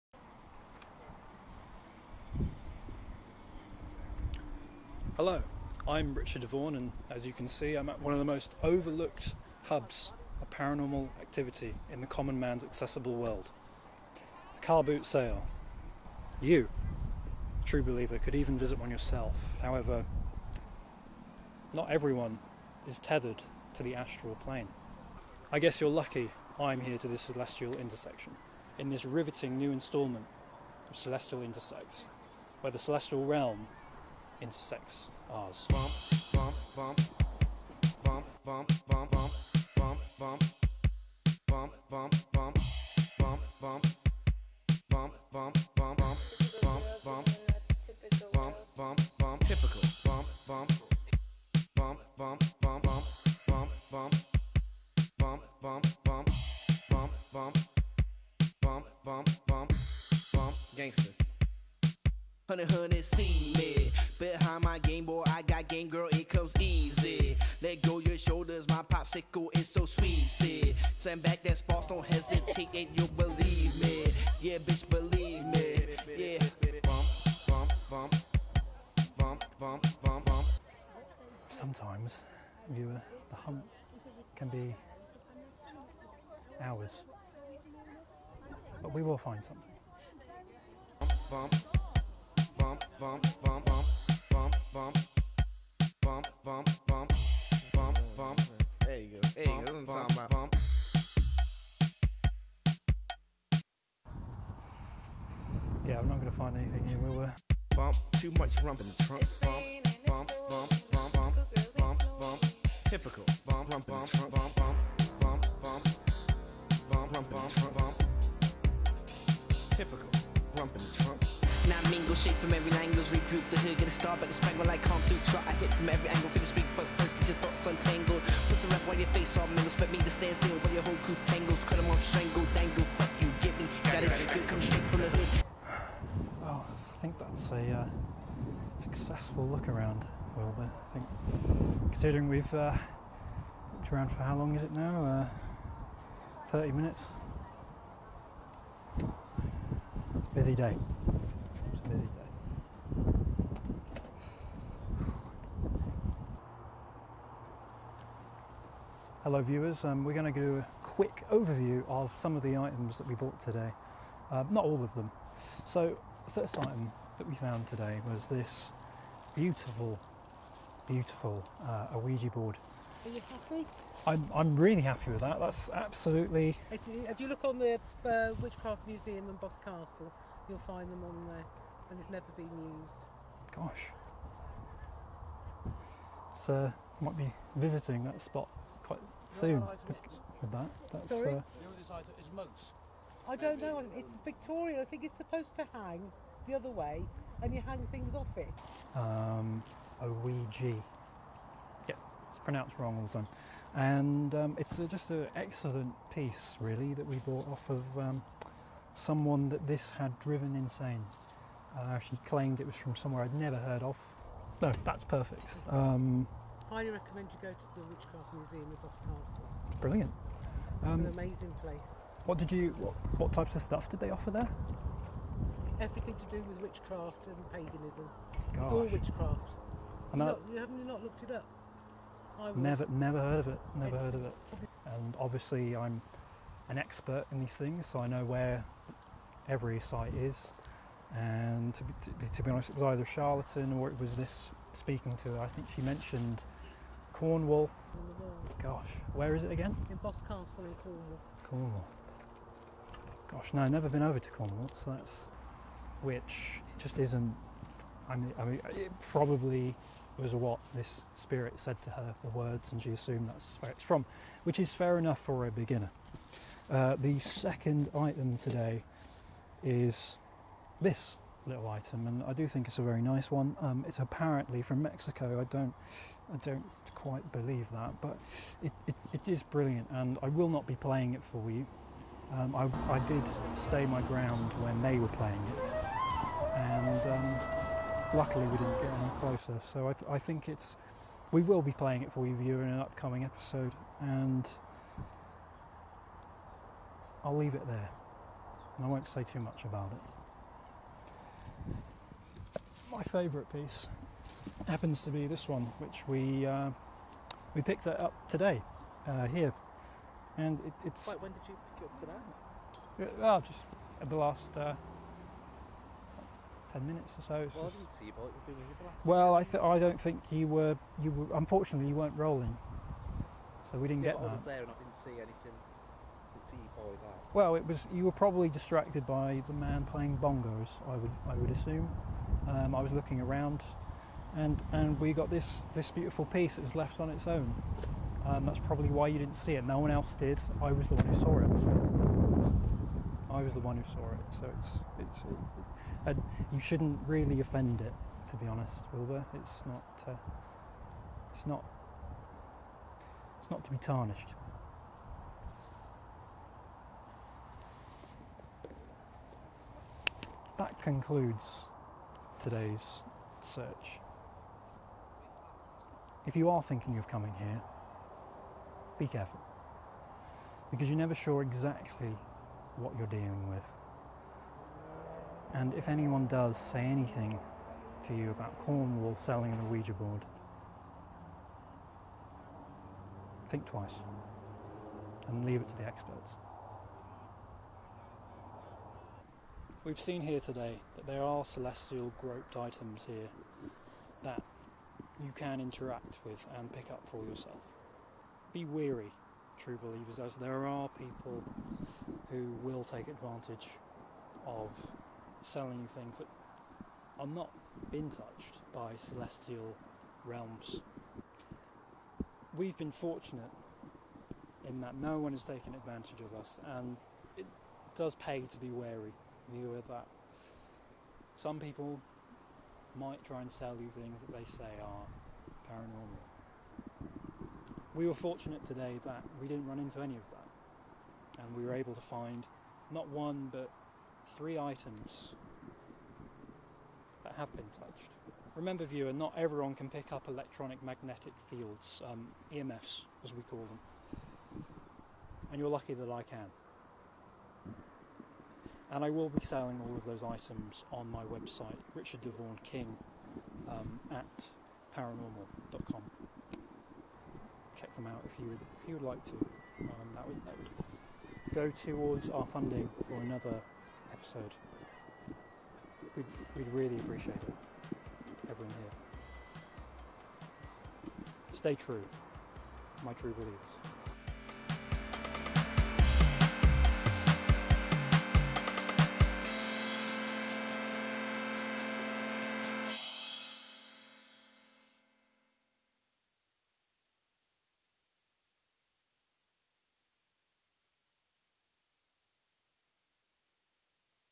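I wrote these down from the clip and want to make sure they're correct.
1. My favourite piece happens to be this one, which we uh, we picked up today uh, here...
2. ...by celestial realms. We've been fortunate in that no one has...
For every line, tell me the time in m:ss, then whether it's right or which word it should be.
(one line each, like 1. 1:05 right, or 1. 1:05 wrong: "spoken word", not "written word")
1. 5:02 right
2. 6:48 right.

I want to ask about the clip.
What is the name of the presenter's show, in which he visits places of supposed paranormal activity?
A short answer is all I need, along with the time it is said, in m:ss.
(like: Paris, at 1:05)
Celestial Intersects, at 0:30.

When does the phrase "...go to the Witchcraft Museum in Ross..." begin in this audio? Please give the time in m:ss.
3:37.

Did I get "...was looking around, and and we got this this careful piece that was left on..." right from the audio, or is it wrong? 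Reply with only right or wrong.
wrong.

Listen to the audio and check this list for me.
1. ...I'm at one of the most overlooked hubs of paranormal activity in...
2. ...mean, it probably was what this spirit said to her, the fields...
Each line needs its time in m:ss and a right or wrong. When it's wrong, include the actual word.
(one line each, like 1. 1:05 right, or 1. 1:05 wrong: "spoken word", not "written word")
1. 0:07 right
2. 4:18 wrong: "words", not "fields".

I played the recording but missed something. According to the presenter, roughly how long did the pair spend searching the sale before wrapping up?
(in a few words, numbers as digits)
30 minutes.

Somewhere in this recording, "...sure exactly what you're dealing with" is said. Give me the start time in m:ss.
6:11.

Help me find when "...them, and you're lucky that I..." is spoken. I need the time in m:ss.
7:23.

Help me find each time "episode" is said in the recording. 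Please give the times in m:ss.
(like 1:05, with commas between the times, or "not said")
4:53, 7:44.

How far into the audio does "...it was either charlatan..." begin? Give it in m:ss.
4:02.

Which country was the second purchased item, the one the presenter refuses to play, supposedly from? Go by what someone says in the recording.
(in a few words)
Mexico.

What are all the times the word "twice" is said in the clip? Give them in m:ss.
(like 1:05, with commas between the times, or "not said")
6:23.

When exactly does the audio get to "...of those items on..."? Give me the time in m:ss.
7:29.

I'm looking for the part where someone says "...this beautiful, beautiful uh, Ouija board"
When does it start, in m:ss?
2:48.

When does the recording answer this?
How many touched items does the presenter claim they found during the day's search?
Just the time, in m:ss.
7:14.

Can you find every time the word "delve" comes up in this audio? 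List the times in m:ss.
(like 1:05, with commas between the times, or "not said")
not said.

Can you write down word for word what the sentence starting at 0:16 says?
You, true believer, could even visit one yourself.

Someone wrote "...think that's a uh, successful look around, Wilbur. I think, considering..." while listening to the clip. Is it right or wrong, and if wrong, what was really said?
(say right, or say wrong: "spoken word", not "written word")
right.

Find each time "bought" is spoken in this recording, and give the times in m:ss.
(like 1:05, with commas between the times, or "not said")
2:43, 3:27.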